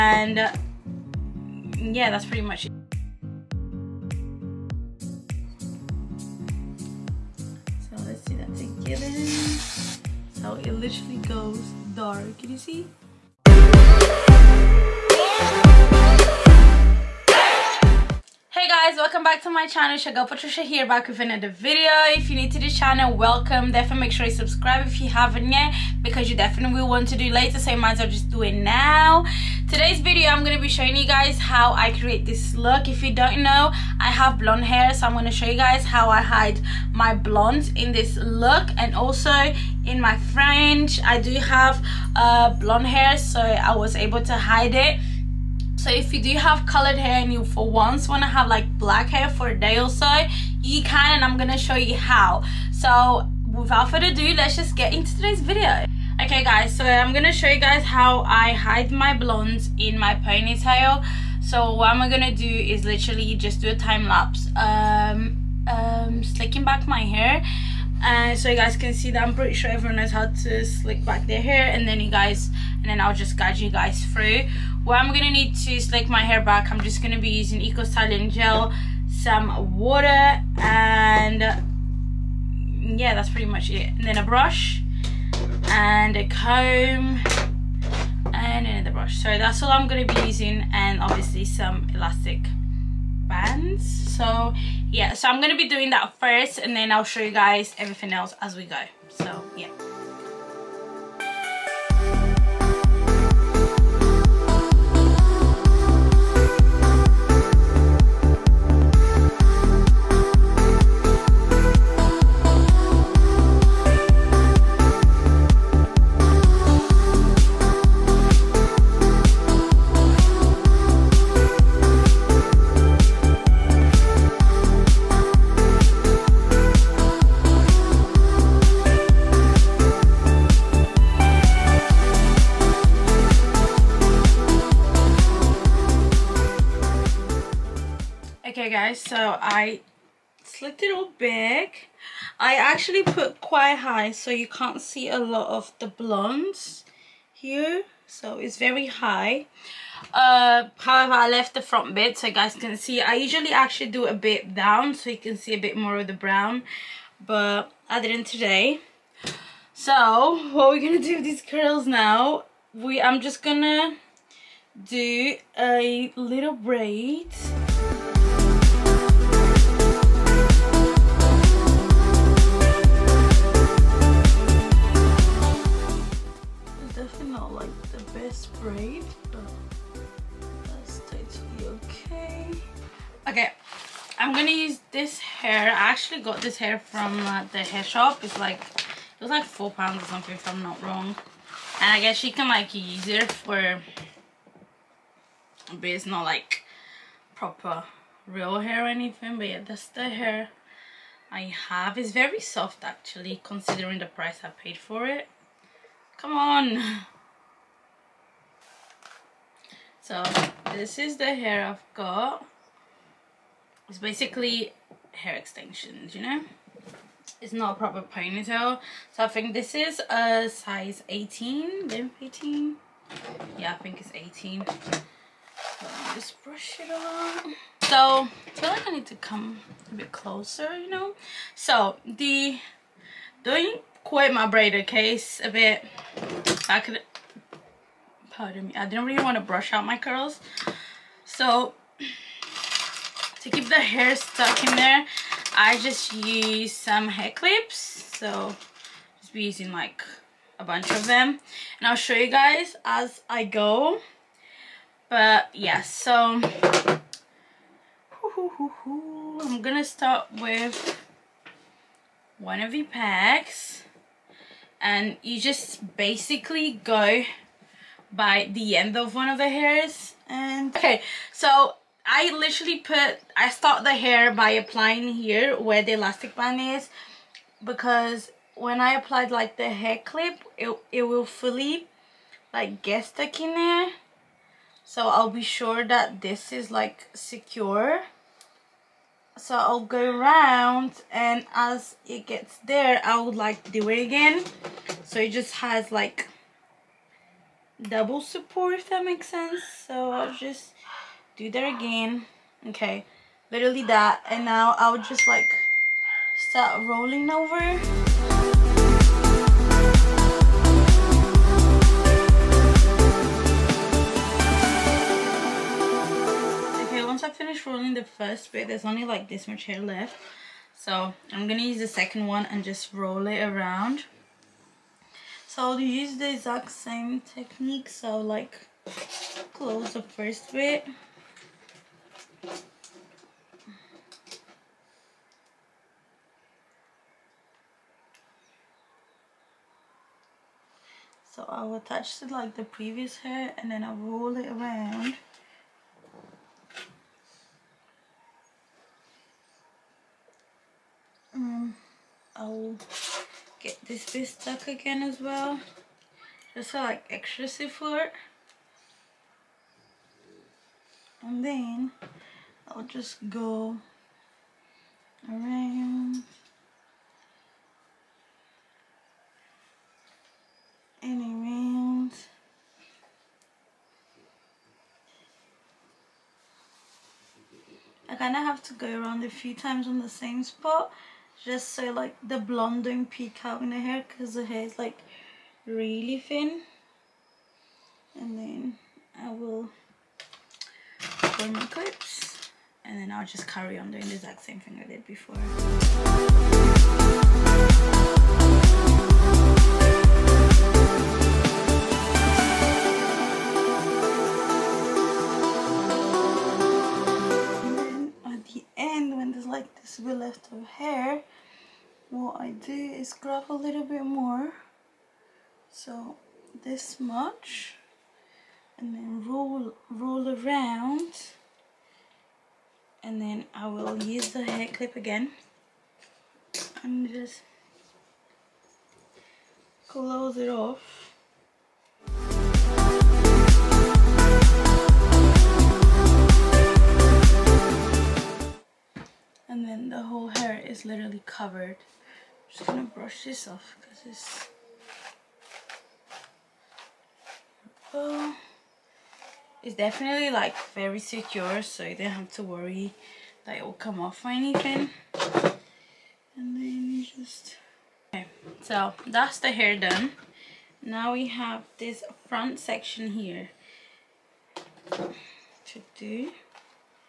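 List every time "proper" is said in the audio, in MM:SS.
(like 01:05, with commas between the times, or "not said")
03:17, 03:37.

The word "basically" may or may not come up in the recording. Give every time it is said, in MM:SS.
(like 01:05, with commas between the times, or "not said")
03:33, 04:25.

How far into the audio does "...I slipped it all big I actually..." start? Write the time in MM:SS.
02:19.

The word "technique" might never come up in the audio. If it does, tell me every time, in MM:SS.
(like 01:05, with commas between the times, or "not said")
05:27.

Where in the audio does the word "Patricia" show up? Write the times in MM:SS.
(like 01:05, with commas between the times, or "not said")
00:20.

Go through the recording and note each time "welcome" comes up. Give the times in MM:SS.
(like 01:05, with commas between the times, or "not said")
00:18, 00:23.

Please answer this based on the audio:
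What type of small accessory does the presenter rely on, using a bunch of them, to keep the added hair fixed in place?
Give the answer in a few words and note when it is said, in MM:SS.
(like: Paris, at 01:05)
hair clips, at 04:07.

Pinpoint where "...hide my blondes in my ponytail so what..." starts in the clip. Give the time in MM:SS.
00:58.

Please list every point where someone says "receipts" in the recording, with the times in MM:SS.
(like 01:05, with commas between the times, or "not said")
not said.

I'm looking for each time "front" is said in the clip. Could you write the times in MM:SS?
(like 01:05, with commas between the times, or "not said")
02:31, 07:42.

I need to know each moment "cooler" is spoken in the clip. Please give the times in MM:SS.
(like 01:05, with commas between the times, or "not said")
not said.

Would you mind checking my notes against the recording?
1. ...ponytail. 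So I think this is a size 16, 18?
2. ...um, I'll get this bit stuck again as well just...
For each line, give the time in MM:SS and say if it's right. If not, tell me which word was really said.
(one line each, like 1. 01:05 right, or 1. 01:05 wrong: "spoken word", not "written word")
1. 03:38 wrong: "18", not "16"
2. 05:51 right.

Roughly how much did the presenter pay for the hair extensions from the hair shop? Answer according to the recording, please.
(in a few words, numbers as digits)
£4.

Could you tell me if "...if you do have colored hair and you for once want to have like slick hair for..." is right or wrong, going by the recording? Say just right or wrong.
wrong.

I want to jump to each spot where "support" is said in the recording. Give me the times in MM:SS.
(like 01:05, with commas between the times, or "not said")
04:58, 05:57.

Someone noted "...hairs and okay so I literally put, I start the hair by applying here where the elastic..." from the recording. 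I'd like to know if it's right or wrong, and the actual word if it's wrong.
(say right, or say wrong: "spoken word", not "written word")
right.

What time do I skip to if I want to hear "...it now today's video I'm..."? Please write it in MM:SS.
00:28.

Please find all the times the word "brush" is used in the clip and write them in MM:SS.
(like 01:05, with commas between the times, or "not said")
01:24, 01:28, 03:46, 03:59, 07:22.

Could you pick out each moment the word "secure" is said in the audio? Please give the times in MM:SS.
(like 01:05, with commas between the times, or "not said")
04:47, 07:30.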